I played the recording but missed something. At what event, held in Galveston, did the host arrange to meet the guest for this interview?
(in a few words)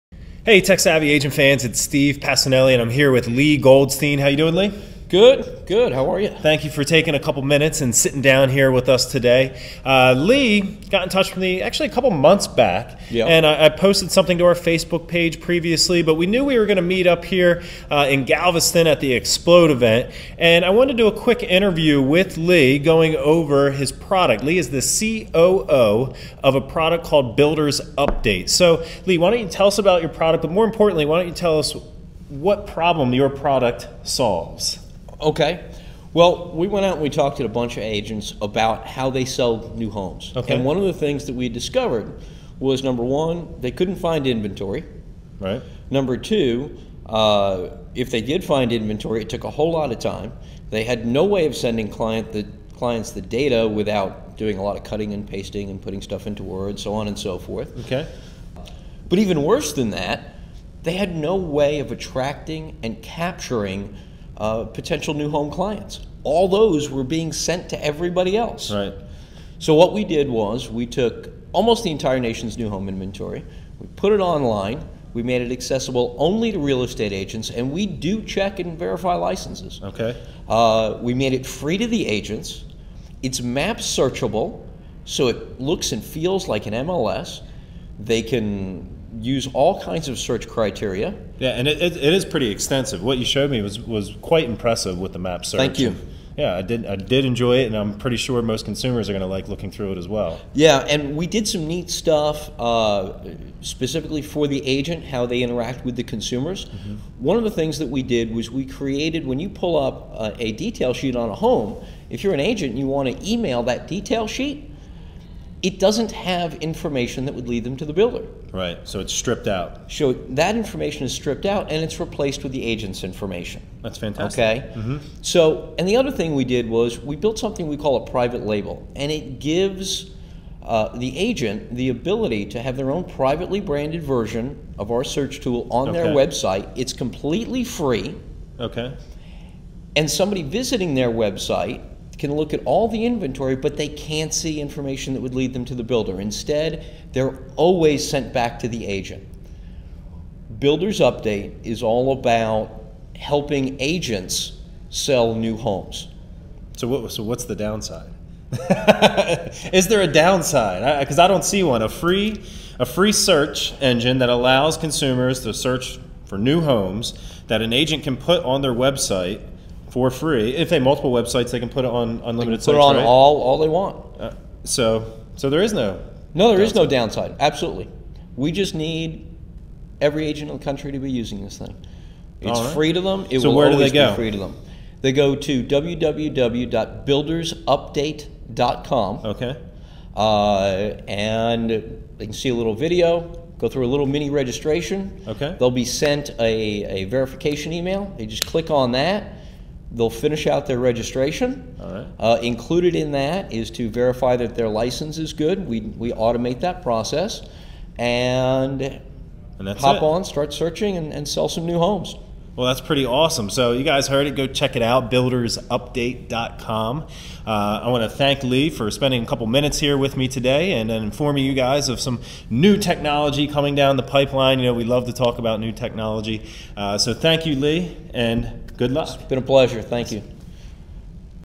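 Explode.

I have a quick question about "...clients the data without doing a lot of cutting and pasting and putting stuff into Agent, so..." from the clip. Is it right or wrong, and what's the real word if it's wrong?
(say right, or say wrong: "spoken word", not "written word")
wrong: "Word", not "Agent".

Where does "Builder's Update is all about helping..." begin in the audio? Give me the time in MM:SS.
02:30.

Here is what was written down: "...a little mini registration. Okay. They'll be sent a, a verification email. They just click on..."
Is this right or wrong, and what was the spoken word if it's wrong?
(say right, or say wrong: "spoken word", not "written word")
right.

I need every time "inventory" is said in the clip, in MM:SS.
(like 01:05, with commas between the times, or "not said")
00:44, 00:48, 01:12, 02:23.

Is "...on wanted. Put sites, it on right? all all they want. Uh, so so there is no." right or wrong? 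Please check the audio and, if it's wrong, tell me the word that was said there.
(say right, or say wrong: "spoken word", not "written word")
wrong: "unlimited", not "wanted".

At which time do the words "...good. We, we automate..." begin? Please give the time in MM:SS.
03:25.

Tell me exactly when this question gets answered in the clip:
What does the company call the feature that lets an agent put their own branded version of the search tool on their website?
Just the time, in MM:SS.
02:08.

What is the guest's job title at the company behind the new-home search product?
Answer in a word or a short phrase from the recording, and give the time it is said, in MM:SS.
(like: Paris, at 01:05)
COO, at 00:25.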